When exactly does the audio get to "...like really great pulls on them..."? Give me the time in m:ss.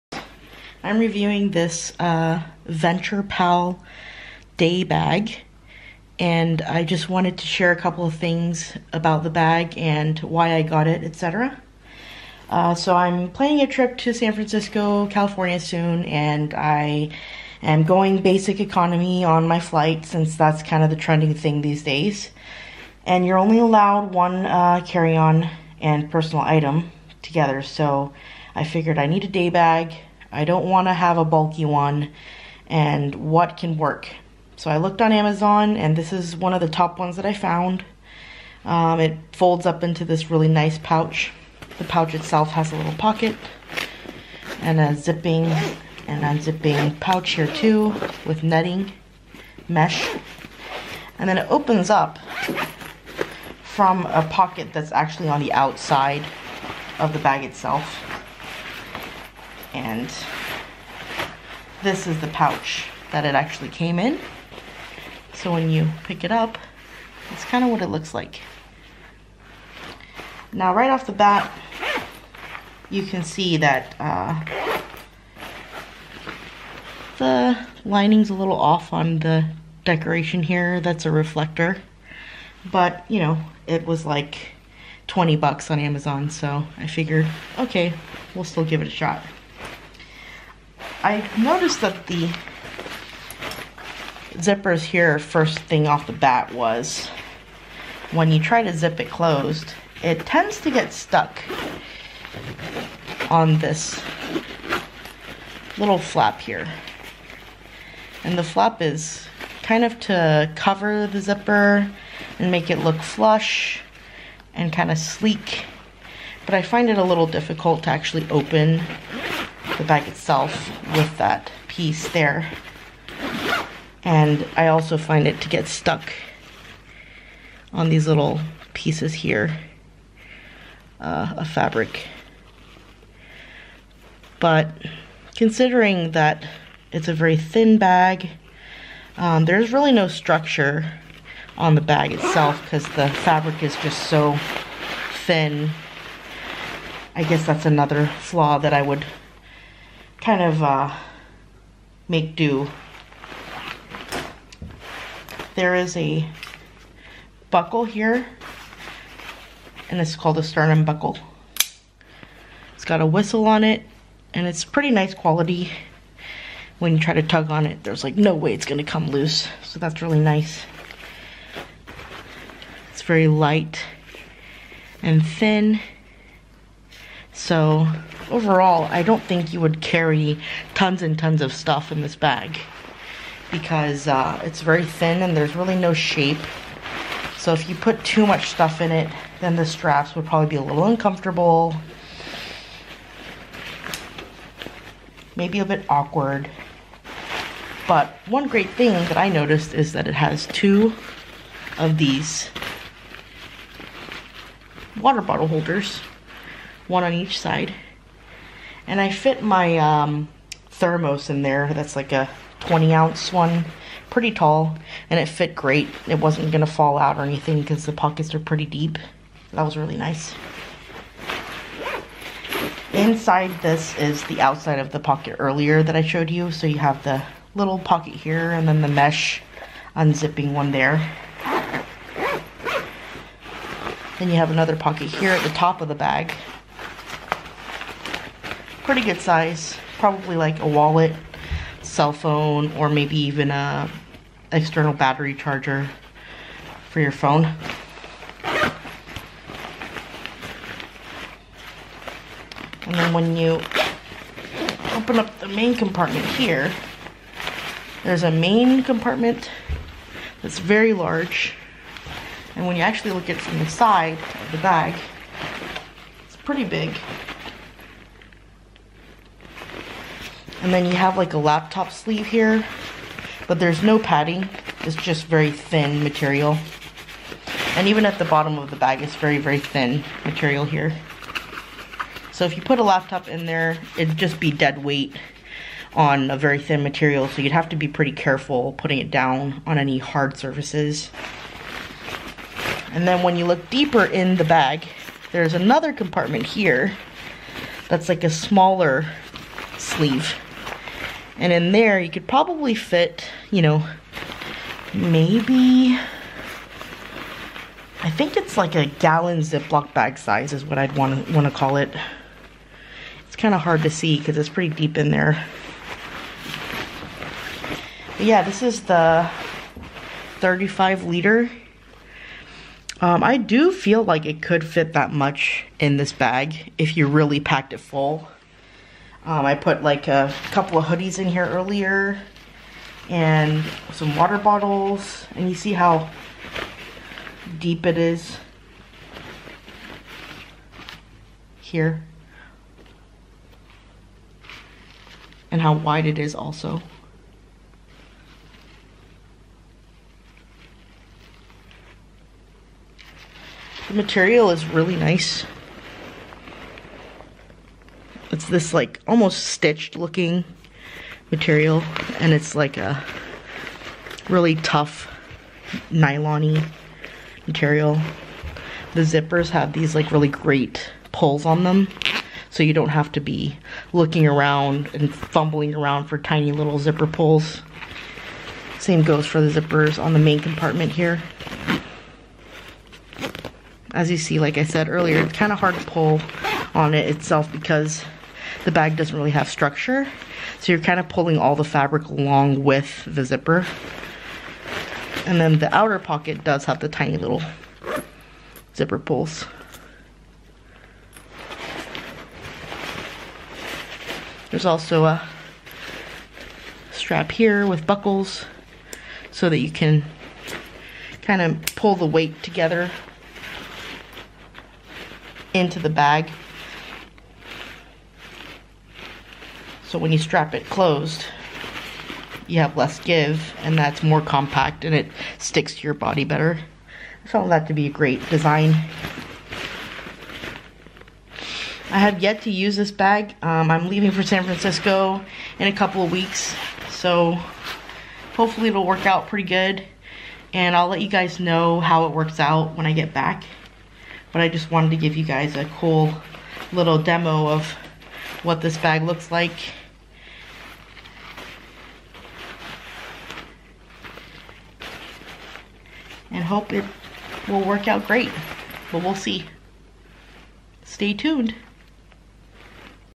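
6:09.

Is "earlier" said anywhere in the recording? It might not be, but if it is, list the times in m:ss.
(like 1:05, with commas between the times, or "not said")
3:45, 5:31, 6:24.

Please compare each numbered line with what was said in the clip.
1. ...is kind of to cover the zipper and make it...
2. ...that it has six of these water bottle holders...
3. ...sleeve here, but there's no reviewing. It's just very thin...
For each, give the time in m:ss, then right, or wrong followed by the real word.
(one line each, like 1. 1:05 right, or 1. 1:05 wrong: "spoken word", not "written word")
1. 1:48 right
2. 3:19 wrong: "two", not "six"
3. 4:31 wrong: "padding", not "reviewing".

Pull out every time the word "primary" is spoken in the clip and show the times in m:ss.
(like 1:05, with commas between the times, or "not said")
not said.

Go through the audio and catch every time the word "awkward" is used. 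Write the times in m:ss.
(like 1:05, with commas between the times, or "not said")
3:15.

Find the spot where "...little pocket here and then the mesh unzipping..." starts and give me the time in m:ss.
3:47.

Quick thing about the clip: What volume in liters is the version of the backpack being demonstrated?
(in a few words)
35 liters.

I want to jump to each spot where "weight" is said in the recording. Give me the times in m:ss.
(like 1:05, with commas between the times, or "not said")
4:44, 6:52.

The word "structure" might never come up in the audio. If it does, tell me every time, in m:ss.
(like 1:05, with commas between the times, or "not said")
2:20, 6:29.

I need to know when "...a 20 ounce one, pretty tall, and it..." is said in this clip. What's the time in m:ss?
3:32.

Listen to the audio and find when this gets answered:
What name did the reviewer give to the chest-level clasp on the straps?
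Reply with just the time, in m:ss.
2:40.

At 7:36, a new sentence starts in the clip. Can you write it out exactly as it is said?
And hope it will work out great, but we'll see.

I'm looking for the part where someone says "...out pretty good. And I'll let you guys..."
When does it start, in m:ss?
7:19.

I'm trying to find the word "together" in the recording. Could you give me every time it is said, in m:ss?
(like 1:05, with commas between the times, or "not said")
0:27, 6:52.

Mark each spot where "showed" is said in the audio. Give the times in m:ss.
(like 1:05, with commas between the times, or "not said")
3:46.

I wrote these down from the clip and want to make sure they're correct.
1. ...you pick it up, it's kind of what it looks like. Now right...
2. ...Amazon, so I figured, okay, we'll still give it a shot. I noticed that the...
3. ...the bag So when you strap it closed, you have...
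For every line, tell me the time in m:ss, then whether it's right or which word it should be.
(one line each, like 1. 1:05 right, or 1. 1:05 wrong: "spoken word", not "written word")
1. 1:05 right
2. 1:25 right
3. 6:55 right.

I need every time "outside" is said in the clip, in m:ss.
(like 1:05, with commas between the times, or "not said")
0:55, 3:44.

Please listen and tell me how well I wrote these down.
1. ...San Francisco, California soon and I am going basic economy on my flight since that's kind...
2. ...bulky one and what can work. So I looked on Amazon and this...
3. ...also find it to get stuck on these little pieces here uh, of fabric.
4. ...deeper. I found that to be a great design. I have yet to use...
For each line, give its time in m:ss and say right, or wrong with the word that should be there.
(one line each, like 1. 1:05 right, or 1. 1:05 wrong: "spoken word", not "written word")
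1. 0:14 right
2. 0:31 right
3. 2:04 right
4. 7:06 wrong: "better", not "deeper".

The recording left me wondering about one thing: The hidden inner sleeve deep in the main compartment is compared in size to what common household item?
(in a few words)
gallon Ziploc bag.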